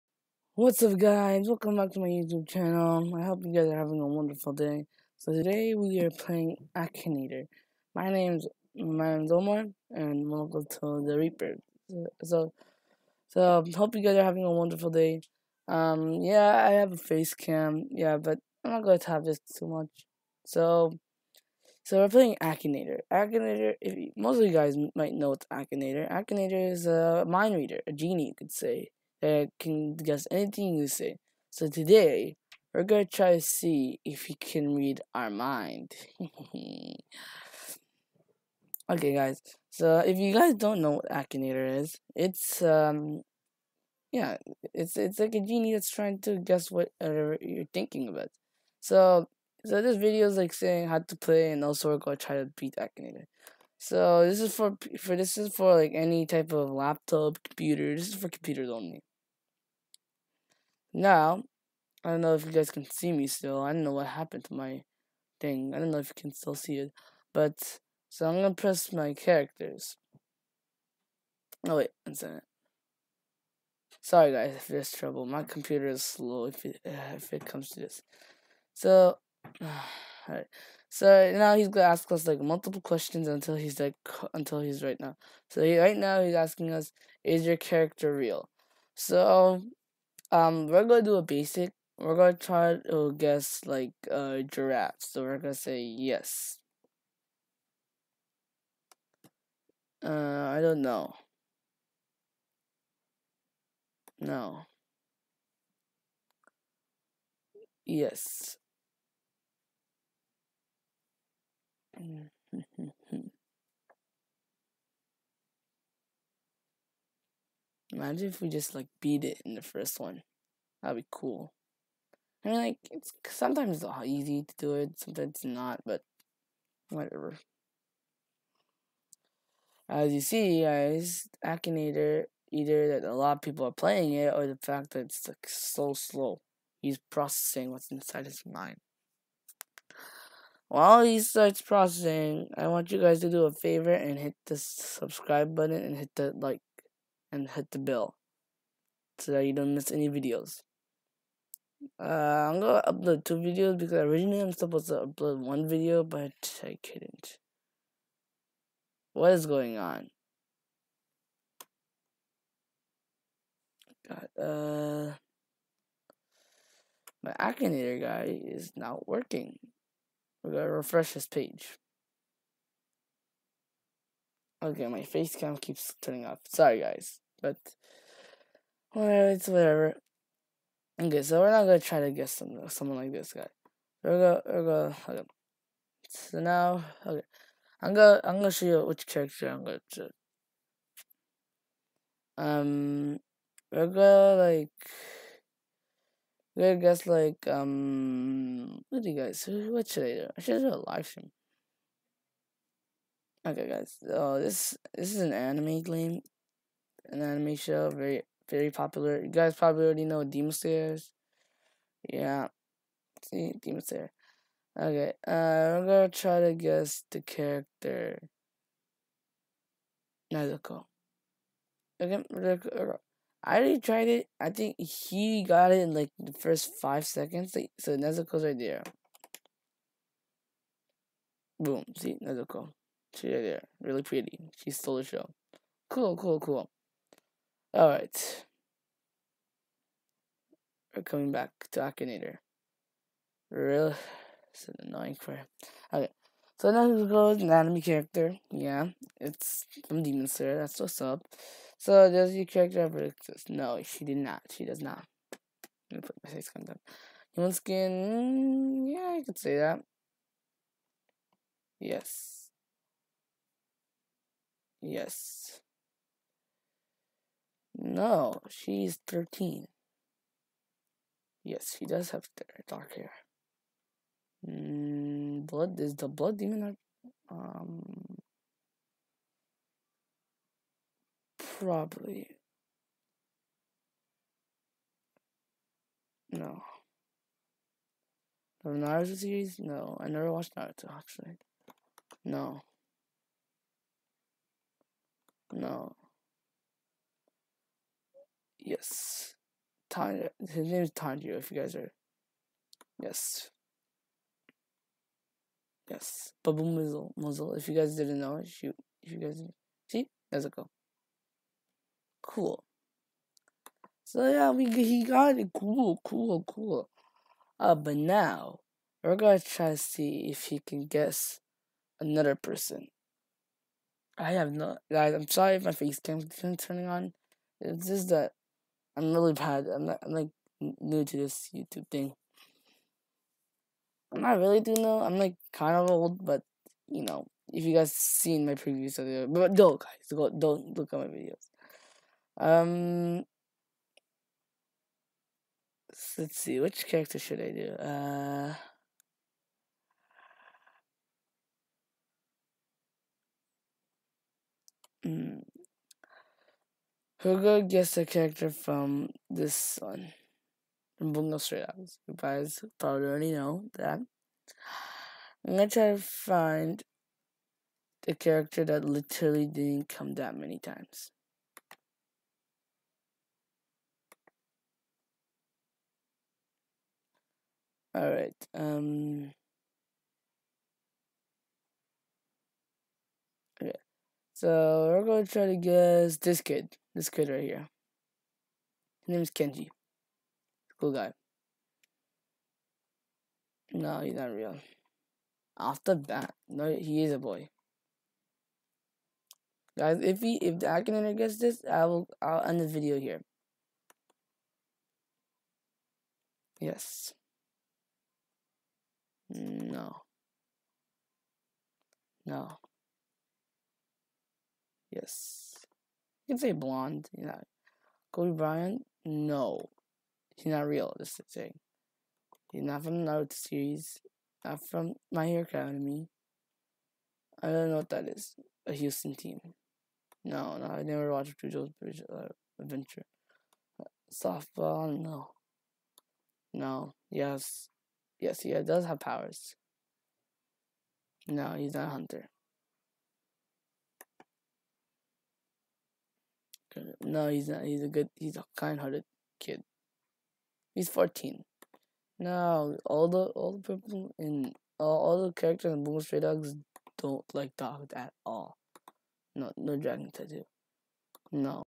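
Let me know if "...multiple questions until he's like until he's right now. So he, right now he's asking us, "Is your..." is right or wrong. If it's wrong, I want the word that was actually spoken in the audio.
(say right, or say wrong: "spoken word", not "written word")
right.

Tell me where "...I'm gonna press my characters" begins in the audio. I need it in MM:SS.
01:08.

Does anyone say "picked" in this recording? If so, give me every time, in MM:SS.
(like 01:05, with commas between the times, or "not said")
not said.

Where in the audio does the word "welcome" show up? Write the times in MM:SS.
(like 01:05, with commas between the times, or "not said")
00:01, 00:10.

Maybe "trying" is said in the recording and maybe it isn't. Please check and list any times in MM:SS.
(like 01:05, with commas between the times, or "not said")
00:45.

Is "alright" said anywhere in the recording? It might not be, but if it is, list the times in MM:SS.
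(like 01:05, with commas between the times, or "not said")
01:20, 03:57, 06:17.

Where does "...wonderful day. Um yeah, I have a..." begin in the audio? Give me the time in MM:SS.
00:14.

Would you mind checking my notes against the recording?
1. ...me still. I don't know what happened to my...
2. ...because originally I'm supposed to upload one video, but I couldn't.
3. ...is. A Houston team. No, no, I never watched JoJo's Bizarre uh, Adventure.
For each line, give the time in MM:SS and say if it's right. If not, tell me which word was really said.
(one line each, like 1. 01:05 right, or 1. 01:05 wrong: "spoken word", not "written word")
1. 01:03 right
2. 02:33 right
3. 07:08 right.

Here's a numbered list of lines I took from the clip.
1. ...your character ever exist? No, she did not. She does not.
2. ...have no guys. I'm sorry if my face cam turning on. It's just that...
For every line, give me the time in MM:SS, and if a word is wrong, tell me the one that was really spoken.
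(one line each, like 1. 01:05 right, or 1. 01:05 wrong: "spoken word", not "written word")
1. 04:12 right
2. 05:24 right.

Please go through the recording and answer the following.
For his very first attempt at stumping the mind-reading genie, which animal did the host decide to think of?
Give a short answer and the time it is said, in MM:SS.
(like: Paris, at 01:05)
Giraffe, at 01:34.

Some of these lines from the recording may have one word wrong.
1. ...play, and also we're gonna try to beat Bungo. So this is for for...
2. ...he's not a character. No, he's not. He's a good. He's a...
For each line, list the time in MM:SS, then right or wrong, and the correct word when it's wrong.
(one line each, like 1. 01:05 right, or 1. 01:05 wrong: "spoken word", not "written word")
1. 00:51 wrong: "Akinator", not "Bungo"
2. 07:21 wrong: "hunter", not "character".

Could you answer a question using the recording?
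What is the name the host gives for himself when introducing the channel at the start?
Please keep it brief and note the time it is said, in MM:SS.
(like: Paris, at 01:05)
Omar, at 00:09.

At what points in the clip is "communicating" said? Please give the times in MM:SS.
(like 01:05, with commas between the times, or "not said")
not said.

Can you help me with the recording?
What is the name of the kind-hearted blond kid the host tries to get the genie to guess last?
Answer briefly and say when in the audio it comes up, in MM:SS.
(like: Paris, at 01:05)
Kenji, at 06:29.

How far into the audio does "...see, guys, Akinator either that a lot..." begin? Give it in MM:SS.
02:10.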